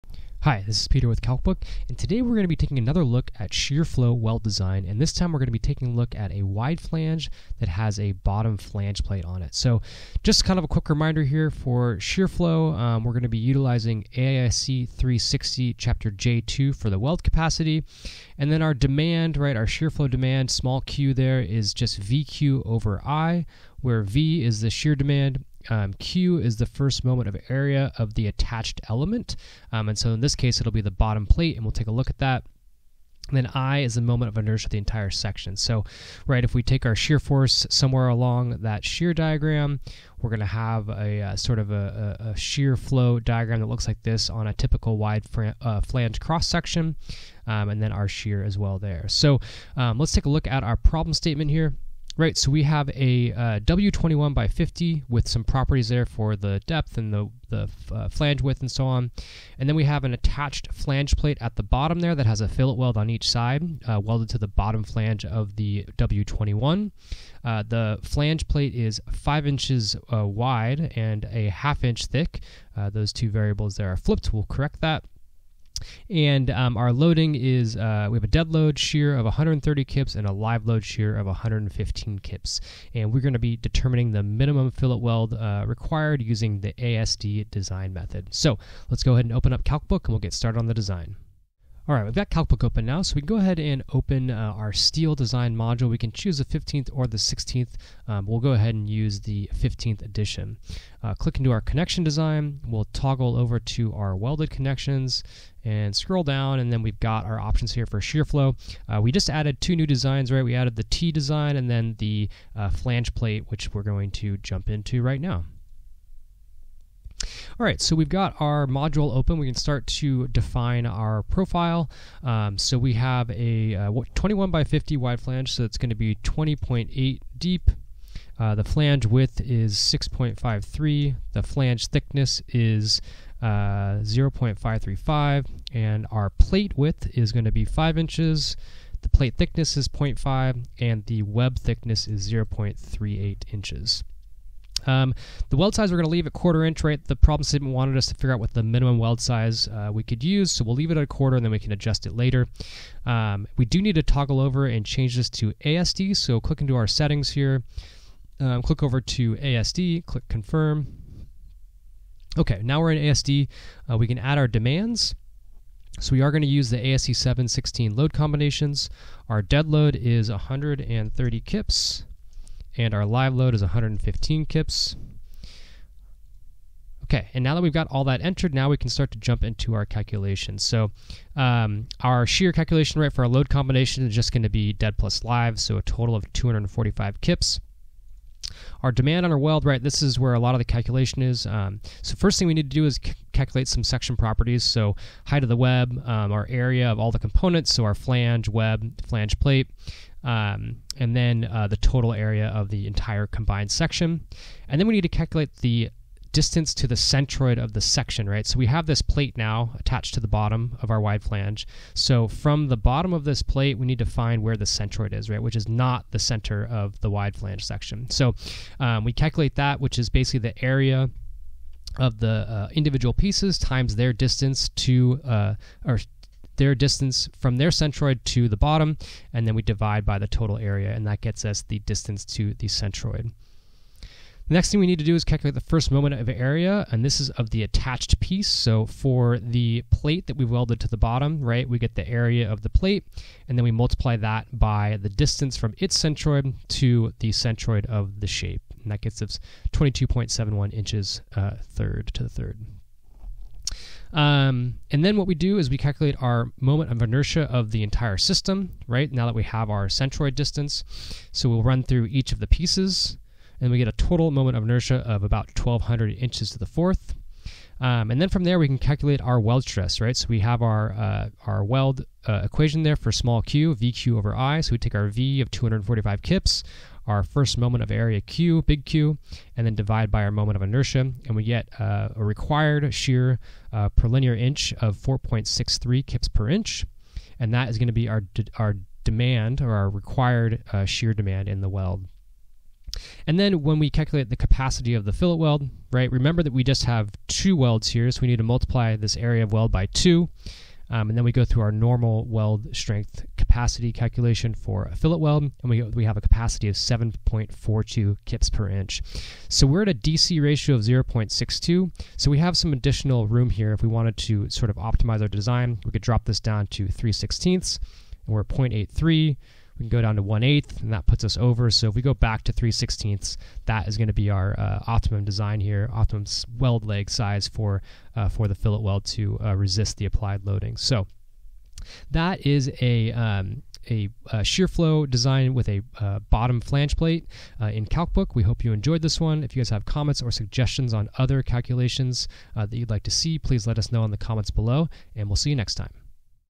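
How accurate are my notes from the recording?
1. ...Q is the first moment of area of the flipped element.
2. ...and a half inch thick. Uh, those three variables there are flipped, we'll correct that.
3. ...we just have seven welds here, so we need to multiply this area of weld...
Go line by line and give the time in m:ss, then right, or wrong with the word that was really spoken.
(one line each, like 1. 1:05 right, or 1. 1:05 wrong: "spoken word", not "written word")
1. 0:25 wrong: "attached", not "flipped"
2. 1:10 wrong: "two", not "three"
3. 4:56 wrong: "two", not "seven".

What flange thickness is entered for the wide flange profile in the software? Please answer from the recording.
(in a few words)
0.535.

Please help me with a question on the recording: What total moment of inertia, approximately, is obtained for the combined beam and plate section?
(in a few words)
1200 inches to the fourth.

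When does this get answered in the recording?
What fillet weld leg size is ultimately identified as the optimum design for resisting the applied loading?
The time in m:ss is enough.
5:22.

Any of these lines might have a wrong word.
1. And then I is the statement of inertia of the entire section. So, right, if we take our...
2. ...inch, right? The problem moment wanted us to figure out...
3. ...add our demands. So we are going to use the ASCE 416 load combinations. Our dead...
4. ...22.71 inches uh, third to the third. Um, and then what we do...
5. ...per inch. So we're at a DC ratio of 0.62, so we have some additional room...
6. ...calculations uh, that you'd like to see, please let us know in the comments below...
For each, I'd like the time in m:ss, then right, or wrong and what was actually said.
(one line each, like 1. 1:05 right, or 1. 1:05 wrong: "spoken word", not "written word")
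1. 0:33 wrong: "moment", not "statement"
2. 2:26 wrong: "statement", not "moment"
3. 2:44 wrong: "716", not "416"
4. 4:09 right
5. 5:08 right
6. 5:41 right.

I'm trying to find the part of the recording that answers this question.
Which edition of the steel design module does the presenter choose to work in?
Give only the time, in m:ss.
1:39.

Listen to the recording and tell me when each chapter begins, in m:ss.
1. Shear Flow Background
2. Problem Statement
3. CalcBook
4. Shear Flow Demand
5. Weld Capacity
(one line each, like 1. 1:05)
1. 0:10
2. 0:50
3. 1:31
4. 3:00
5. 4:50.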